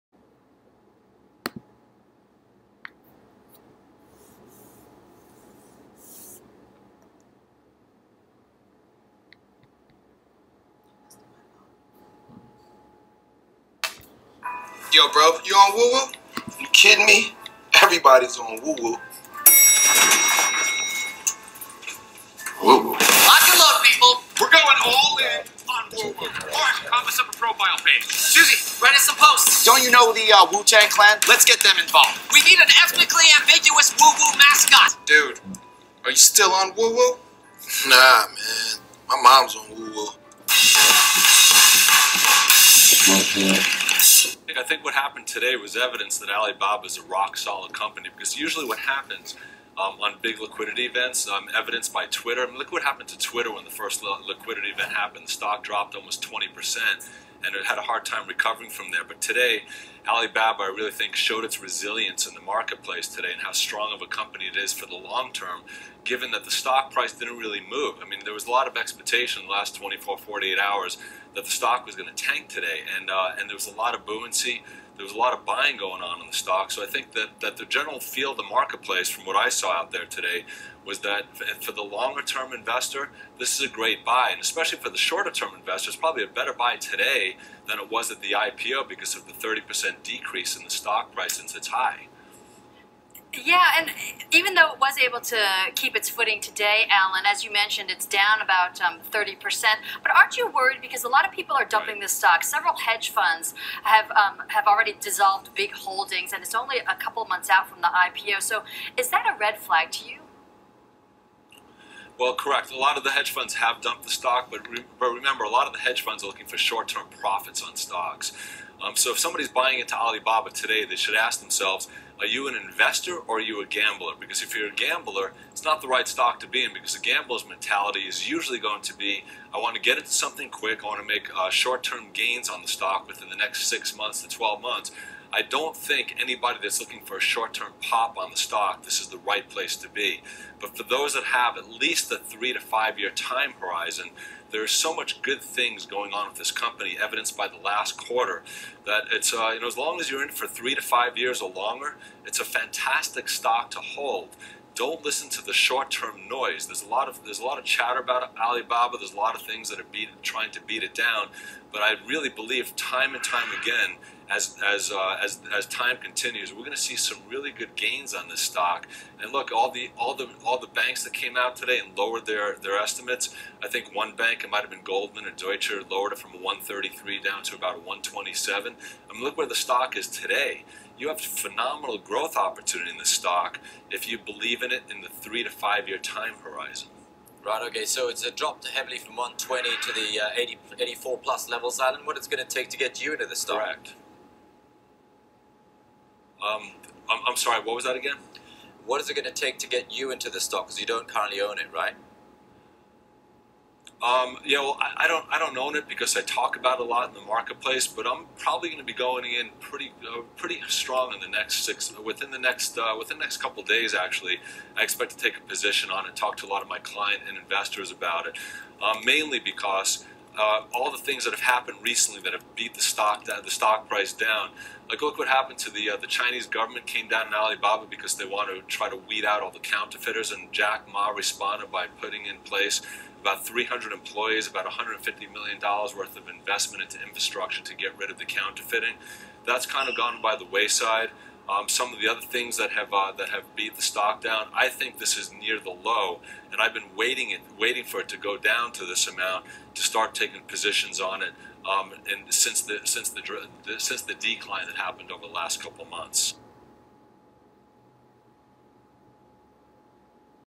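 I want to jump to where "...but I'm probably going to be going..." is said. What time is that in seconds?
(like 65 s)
207 s.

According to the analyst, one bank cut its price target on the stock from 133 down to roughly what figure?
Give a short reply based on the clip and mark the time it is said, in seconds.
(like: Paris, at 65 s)
127, at 177 s.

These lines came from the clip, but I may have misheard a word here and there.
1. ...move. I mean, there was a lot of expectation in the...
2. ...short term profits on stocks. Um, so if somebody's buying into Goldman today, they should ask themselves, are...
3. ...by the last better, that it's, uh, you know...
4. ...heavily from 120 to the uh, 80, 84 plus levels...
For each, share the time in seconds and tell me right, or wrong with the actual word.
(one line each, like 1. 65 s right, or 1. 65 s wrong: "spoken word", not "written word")
1. 67 s right
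2. 116 s wrong: "Alibaba", not "Goldman"
3. 147 s wrong: "quarter", not "better"
4. 188 s right.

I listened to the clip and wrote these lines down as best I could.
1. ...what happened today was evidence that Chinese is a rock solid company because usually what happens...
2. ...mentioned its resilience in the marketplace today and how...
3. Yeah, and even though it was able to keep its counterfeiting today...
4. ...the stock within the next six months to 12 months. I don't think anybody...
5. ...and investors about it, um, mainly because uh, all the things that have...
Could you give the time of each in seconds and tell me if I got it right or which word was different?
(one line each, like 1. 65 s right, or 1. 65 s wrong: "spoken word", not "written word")
1. 44 s wrong: "Alibaba", not "Chinese"
2. 61 s wrong: "showed", not "mentioned"
3. 93 s wrong: "footing", not "counterfeiting"
4. 132 s right
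5. 217 s right.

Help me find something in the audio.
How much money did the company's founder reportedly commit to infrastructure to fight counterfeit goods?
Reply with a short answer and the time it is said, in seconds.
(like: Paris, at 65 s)
150 million dollars, at 234 s.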